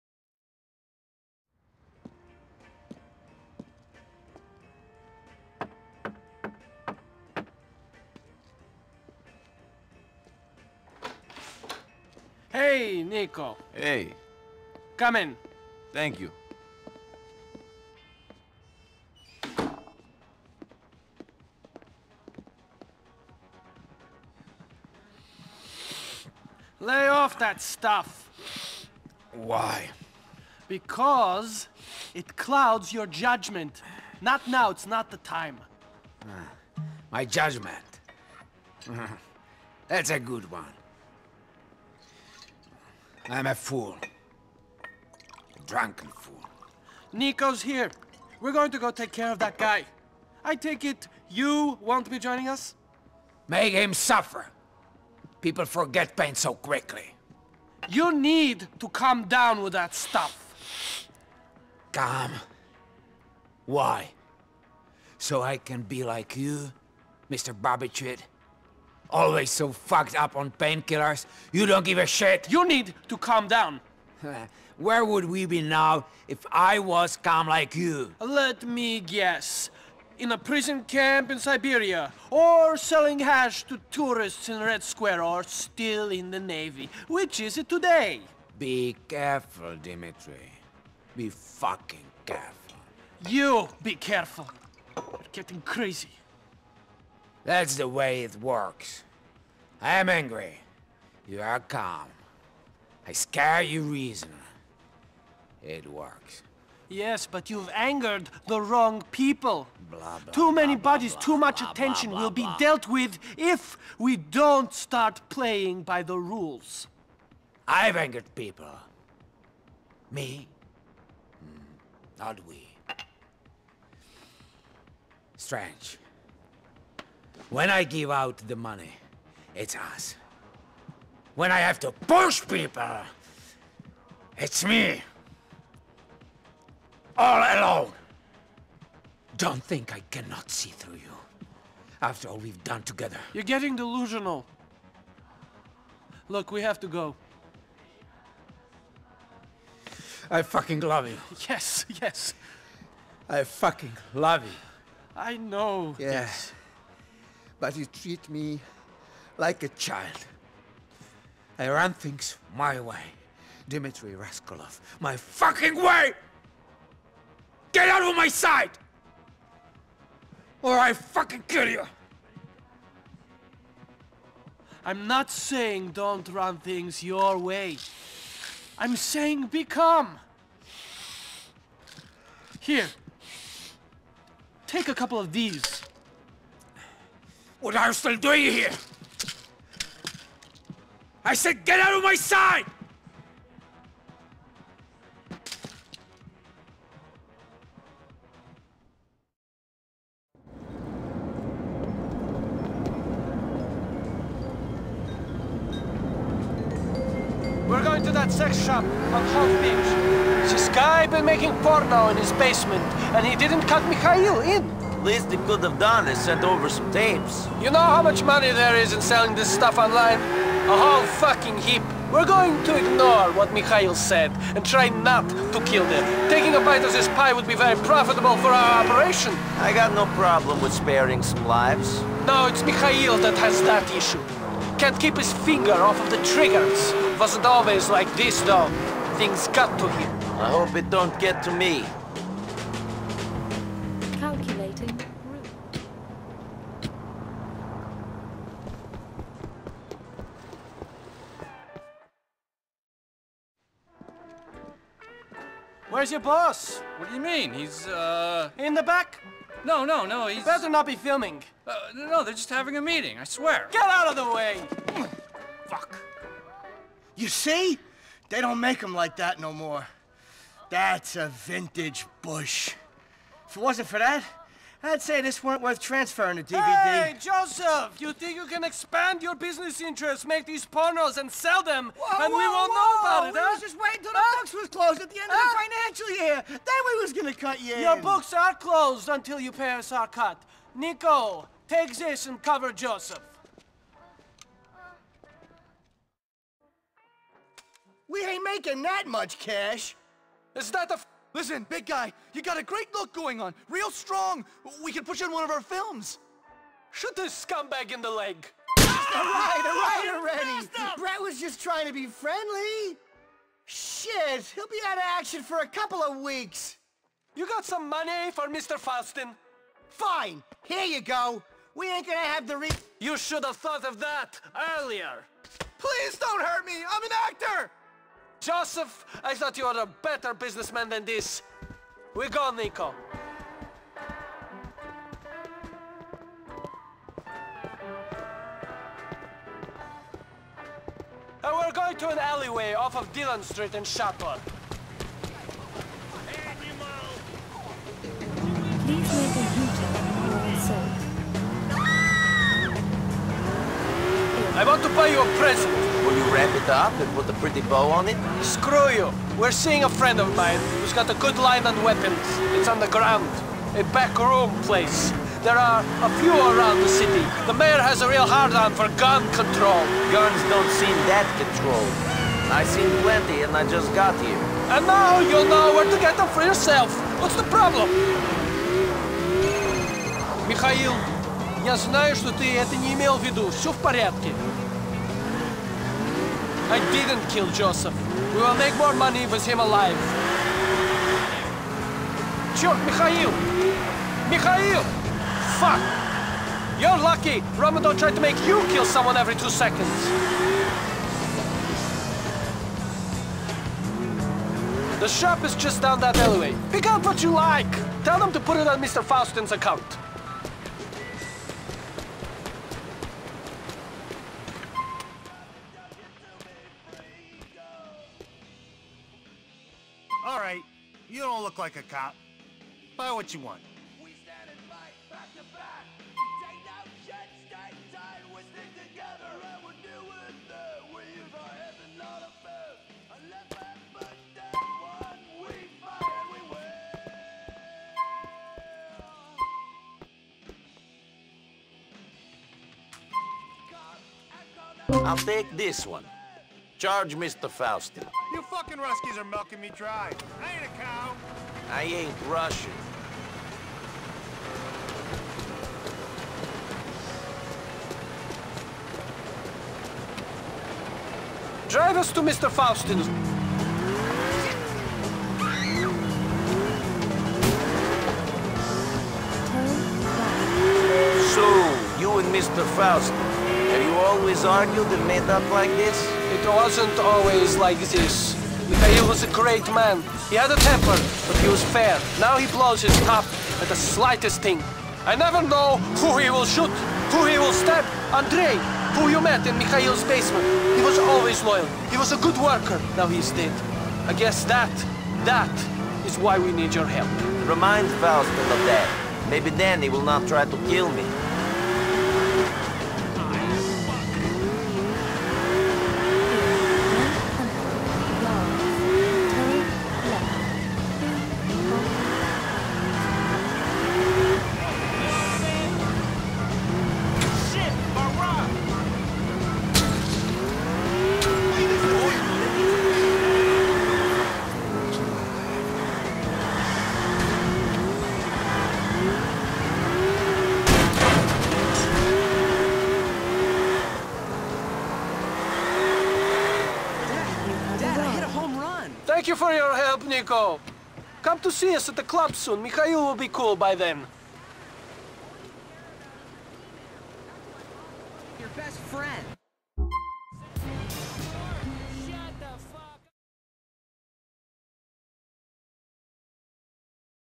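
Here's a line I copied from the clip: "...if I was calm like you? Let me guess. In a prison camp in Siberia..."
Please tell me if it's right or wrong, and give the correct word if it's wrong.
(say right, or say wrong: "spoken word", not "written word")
right.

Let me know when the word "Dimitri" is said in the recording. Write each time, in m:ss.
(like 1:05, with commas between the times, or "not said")
1:29, 2:43.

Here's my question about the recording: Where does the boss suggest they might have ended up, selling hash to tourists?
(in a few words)
Red Square.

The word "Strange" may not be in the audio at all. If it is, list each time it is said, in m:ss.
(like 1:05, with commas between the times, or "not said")
2:05.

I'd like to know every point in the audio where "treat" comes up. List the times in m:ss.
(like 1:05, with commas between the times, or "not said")
2:37.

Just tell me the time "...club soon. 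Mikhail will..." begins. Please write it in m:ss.
9:02.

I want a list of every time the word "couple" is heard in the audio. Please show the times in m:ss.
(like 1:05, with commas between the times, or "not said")
3:04, 5:15.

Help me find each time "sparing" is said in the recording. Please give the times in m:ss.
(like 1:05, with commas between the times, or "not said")
3:50.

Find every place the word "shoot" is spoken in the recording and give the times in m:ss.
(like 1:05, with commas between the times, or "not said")
5:06, 8:06.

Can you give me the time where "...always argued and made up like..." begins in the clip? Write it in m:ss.
7:53.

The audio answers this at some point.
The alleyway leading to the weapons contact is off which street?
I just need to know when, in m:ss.
5:43.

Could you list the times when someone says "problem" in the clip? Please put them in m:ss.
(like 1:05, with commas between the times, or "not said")
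3:50, 6:17.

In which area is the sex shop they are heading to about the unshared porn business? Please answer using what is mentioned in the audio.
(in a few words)
Hove Beach.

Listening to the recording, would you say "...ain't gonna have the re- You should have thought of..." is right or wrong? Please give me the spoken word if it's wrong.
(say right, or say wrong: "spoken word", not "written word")
right.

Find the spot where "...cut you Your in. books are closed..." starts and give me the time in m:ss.
4:47.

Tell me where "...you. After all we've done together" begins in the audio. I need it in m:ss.
2:20.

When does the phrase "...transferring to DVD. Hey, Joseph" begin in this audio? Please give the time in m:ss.
4:35.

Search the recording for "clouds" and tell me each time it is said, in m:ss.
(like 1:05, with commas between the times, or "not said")
0:32.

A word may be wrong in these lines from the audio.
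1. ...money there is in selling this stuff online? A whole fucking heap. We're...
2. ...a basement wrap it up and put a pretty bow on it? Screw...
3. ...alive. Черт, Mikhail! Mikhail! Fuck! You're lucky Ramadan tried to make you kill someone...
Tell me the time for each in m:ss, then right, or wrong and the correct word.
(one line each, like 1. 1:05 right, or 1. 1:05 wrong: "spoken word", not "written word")
1. 3:38 right
2. 5:55 wrong: "present", not "basement"
3. 6:29 right.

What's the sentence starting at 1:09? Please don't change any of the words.
Always so fucked up on painkillers.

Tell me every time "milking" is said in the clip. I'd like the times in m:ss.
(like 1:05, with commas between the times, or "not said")
7:29.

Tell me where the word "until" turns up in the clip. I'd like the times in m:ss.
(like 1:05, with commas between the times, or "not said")
4:43, 4:49.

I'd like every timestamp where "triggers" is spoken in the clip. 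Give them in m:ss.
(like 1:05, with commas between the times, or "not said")
3:56.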